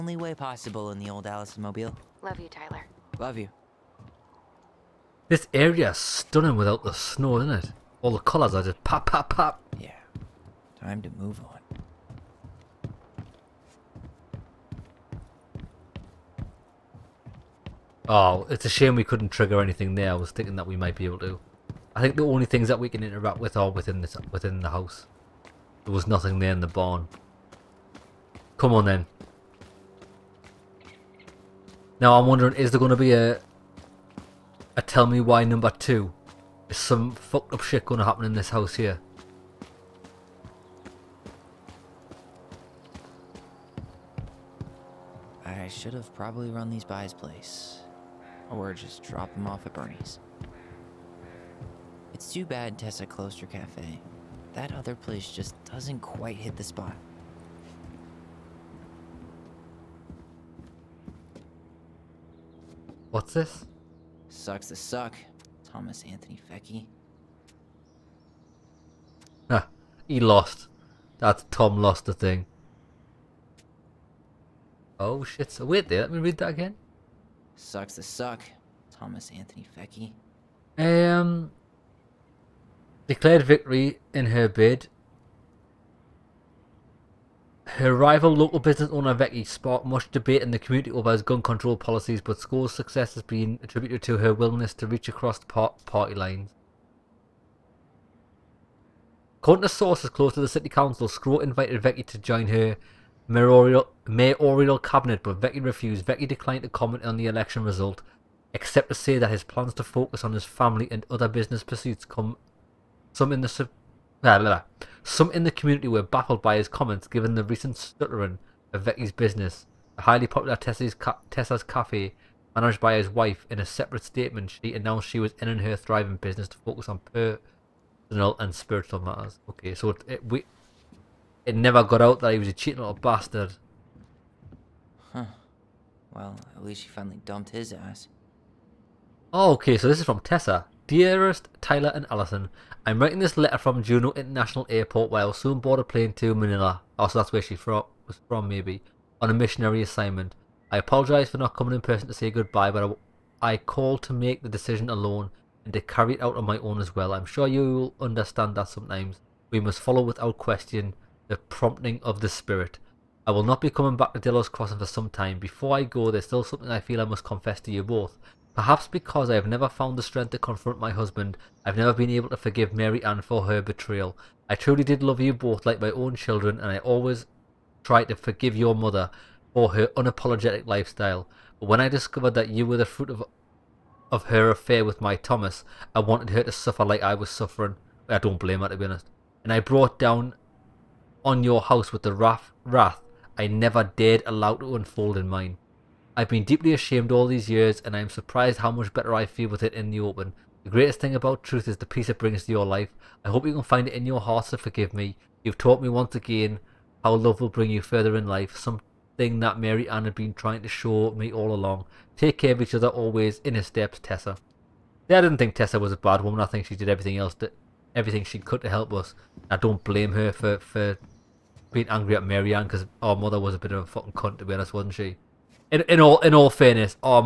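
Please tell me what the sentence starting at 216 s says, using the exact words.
I think she did everything else, that, everything she could to help us.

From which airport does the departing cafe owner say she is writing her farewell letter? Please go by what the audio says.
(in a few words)
Juneau International Airport.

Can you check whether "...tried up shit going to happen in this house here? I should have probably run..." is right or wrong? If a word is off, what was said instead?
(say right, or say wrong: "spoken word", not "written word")
wrong: "fucked", not "tried".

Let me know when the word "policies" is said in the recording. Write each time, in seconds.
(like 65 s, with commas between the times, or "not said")
91 s.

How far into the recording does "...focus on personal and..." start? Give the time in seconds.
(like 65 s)
126 s.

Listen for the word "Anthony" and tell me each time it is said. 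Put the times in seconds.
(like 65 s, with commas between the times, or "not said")
66 s, 79 s.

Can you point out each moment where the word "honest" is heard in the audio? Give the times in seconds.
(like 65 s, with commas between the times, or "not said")
188 s, 224 s.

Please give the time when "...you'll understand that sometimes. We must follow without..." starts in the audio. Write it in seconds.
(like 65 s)
157 s.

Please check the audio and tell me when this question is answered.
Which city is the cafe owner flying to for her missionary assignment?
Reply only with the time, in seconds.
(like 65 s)
146 s.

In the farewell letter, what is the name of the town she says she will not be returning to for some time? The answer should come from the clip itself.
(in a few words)
Delos Crossing.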